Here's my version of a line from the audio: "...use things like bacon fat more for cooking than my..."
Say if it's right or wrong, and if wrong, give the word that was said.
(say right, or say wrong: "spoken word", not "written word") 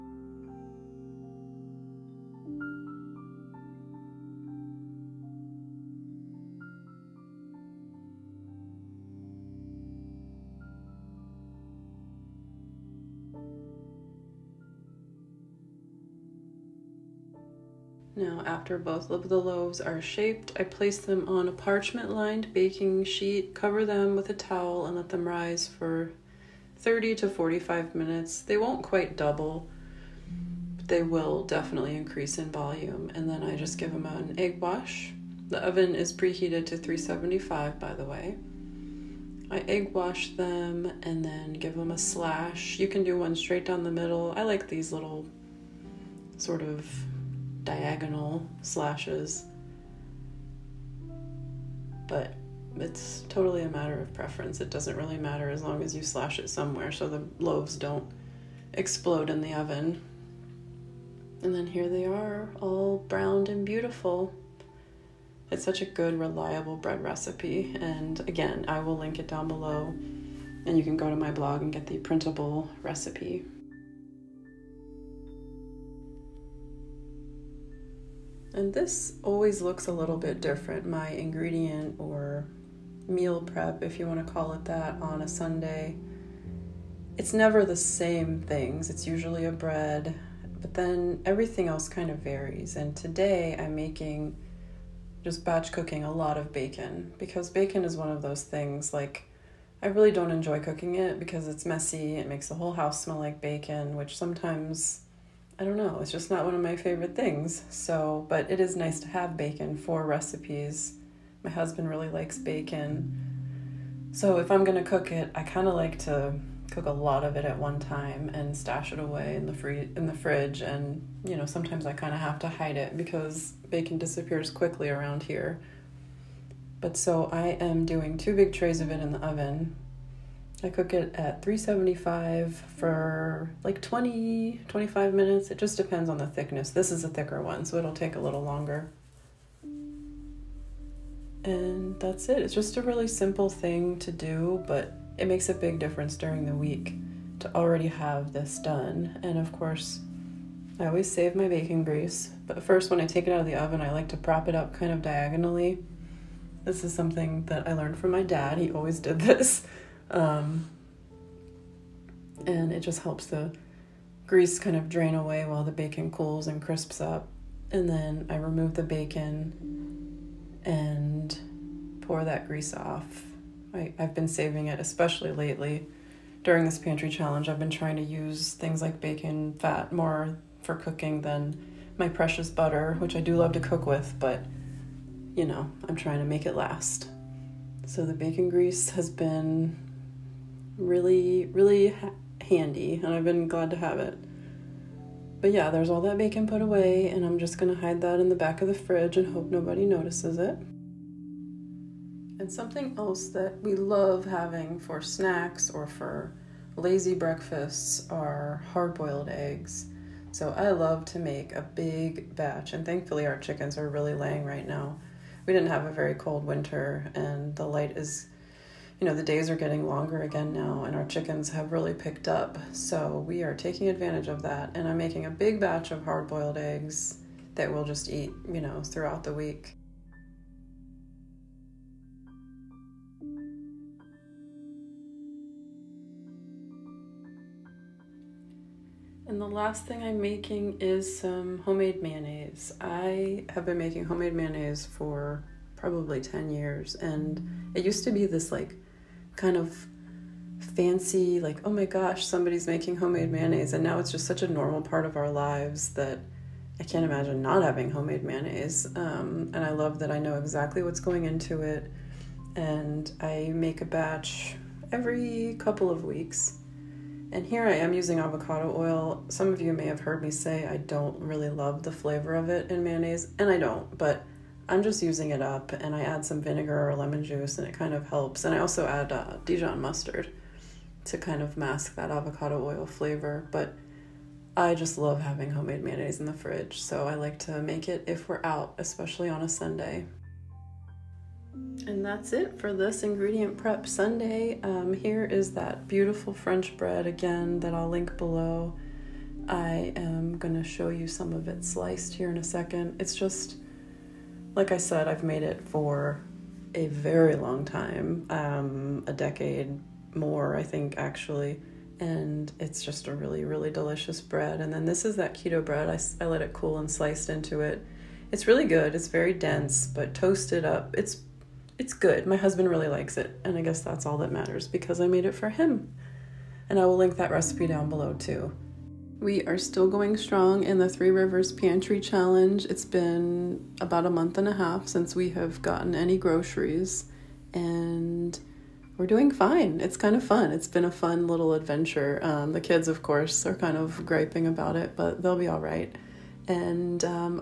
right.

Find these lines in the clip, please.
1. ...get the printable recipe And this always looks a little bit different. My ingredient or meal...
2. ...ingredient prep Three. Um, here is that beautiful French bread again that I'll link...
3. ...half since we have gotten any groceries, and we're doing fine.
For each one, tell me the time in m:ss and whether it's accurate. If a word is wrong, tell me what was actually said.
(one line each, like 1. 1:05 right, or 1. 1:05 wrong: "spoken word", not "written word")
1. 1:11 right
2. 4:53 wrong: "Sunday", not "Three"
3. 5:34 right.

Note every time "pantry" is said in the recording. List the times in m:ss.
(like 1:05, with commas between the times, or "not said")
2:56, 5:31.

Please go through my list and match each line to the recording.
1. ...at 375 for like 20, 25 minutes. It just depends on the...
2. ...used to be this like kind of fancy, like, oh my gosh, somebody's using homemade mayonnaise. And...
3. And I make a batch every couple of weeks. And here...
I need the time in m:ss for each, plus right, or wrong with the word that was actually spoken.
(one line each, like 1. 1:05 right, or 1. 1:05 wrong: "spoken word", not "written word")
1. 2:11 right
2. 4:07 wrong: "making", not "using"
3. 4:22 right.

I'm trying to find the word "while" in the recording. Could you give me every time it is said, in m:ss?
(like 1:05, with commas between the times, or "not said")
2:45.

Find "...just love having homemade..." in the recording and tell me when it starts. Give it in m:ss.
4:44.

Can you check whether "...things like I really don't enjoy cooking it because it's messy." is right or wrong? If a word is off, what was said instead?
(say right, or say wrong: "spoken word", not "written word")
right.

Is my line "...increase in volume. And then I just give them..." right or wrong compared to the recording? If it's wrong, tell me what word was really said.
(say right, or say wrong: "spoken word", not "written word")
right.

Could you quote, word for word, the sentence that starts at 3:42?
So we are taking advantage of that.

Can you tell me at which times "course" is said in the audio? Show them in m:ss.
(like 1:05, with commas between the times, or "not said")
2:29, 5:43.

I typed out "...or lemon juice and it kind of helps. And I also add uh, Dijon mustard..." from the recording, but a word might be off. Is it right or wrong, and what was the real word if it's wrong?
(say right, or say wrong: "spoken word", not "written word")
right.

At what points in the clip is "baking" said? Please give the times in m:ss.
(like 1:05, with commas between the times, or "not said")
0:22, 2:31.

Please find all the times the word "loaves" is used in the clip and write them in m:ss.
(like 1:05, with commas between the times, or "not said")
0:19, 0:57.